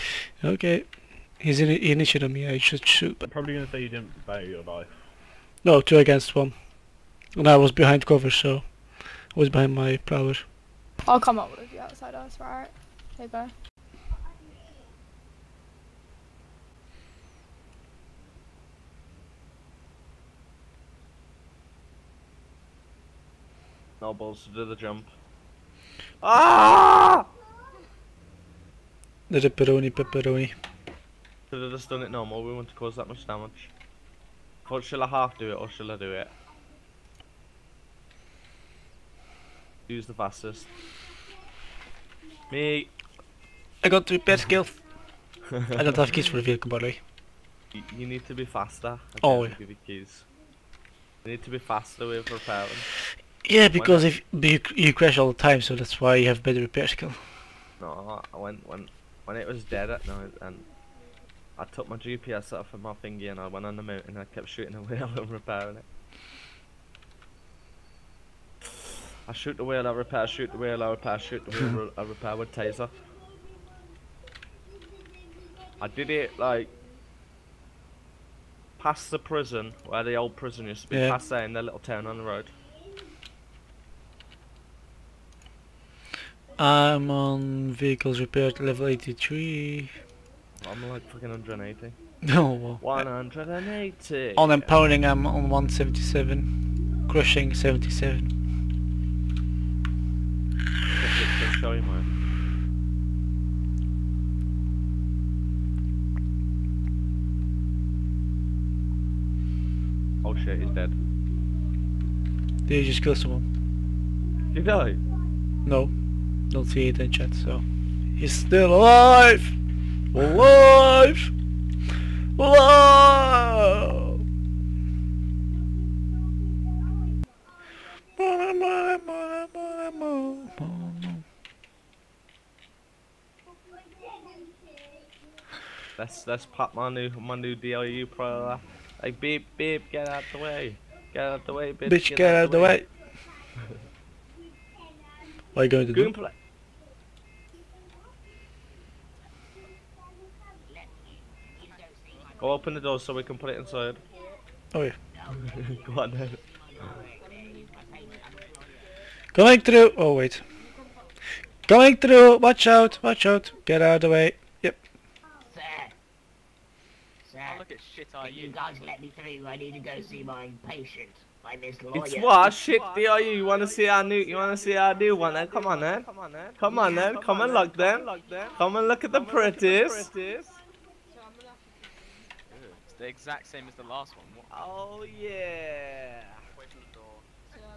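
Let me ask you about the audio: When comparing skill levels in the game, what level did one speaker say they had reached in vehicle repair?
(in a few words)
83.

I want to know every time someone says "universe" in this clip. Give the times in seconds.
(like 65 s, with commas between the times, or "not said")
not said.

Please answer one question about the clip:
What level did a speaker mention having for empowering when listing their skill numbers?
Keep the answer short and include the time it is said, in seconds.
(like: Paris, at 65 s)
177, at 95 s.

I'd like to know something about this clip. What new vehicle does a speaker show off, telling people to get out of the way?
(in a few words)
DLU pro.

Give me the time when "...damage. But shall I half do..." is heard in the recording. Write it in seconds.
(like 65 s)
33 s.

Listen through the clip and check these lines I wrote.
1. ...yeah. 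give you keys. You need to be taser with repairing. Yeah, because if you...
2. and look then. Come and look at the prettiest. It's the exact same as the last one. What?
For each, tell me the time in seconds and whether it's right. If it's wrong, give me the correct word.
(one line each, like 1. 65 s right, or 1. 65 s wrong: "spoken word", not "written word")
1. 49 s wrong: "faster", not "taser"
2. 177 s right.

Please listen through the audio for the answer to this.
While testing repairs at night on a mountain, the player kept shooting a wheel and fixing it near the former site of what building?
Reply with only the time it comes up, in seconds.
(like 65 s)
80 s.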